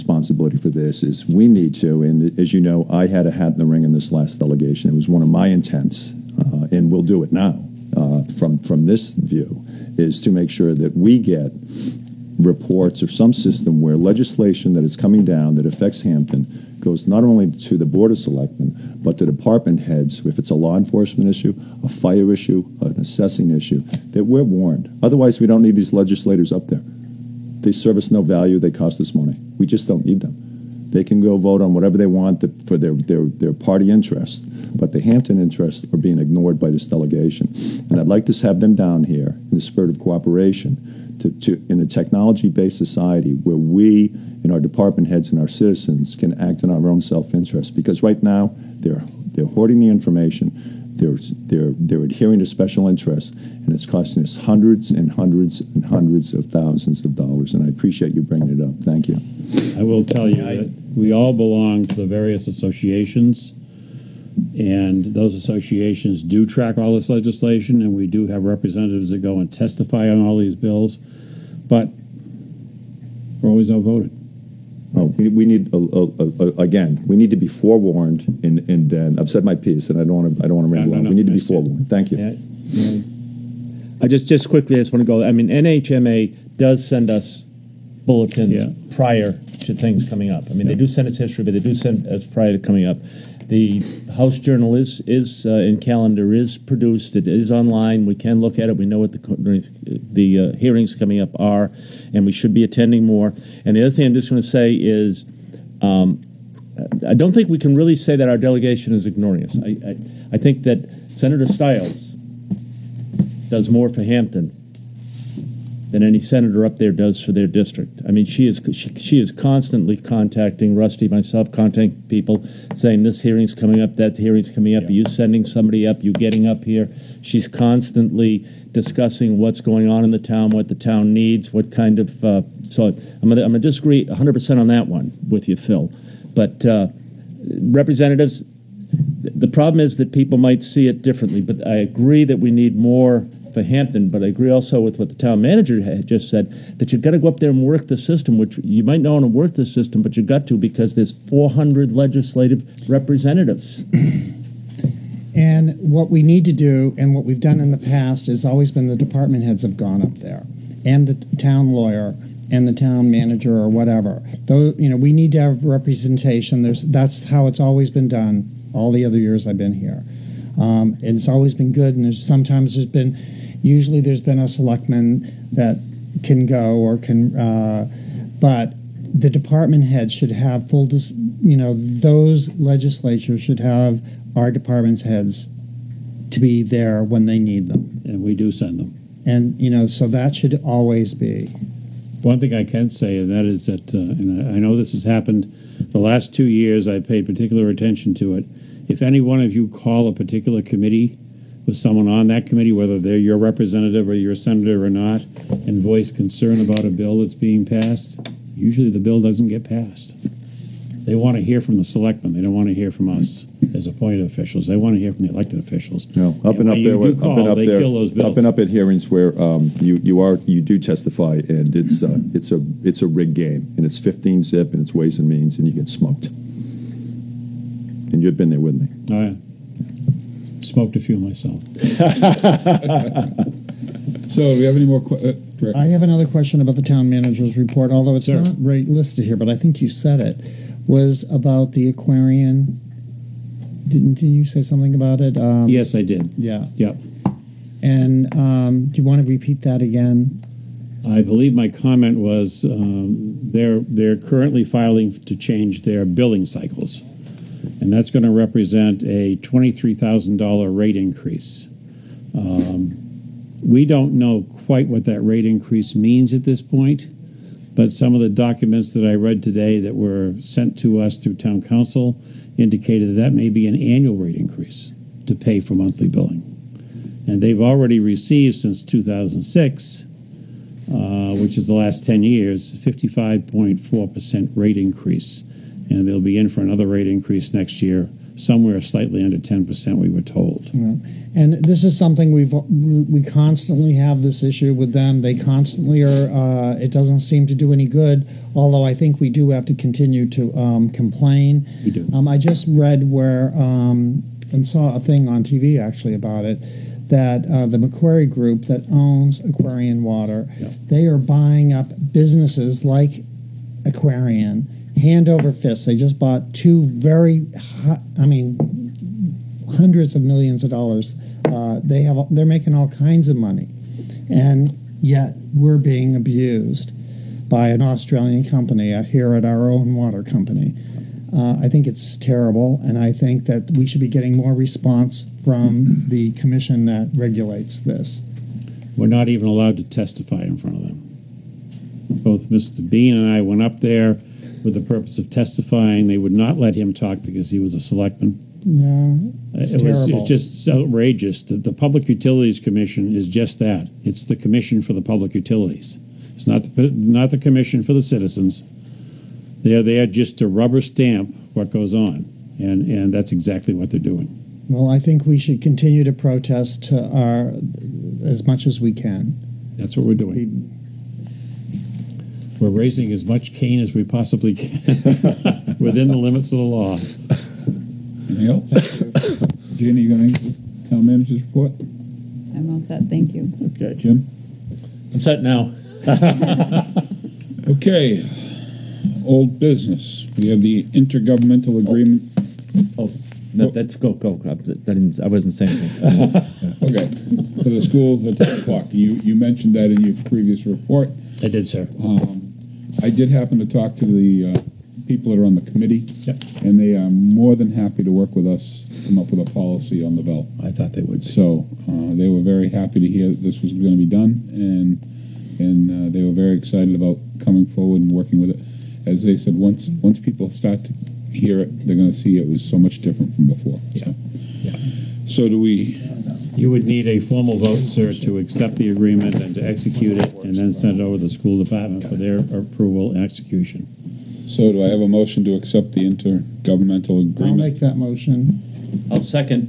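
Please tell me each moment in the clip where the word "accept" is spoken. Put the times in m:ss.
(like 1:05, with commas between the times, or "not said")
7:08, 7:15.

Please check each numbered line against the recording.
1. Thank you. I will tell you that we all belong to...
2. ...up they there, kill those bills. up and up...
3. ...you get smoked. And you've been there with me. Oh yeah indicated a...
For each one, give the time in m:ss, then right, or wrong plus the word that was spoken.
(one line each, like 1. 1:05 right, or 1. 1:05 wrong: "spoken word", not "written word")
1. 0:58 right
2. 3:37 right
3. 3:45 wrong: "smoked", not "indicated".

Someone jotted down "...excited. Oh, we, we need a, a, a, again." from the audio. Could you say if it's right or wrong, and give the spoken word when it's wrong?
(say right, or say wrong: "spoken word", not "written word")
wrong: "outvoted", not "excited".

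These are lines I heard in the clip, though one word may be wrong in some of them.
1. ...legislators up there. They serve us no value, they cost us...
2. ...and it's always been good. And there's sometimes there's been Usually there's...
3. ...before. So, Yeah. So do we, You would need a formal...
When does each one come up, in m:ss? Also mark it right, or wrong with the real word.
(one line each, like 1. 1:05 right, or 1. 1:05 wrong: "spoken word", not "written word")
1. 0:25 right
2. 2:51 right
3. 7:03 right.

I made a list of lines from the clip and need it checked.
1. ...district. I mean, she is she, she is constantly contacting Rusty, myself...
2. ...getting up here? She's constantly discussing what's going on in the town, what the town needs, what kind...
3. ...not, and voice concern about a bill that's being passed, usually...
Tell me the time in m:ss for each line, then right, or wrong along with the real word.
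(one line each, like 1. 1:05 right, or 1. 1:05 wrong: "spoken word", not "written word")
1. 1:57 right
2. 2:06 right
3. 3:24 right.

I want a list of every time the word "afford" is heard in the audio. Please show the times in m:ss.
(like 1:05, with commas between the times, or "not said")
not said.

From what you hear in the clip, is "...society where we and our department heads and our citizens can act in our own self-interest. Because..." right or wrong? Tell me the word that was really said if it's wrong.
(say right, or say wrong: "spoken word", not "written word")
right.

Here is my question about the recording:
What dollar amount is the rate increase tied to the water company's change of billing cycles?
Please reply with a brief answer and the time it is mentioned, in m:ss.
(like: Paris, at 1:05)
$23,000, at 4:19.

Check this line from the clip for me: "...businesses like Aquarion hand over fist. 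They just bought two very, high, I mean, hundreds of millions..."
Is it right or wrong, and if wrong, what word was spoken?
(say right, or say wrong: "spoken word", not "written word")
right.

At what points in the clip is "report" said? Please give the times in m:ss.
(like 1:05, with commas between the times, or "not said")
0:12, 3:57, 6:21, 6:40.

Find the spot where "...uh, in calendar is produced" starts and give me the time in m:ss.
1:35.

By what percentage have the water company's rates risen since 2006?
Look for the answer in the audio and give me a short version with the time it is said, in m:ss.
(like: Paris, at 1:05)
55.4%, at 4:42.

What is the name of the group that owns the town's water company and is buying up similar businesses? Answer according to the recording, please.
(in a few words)
Macquarie Group.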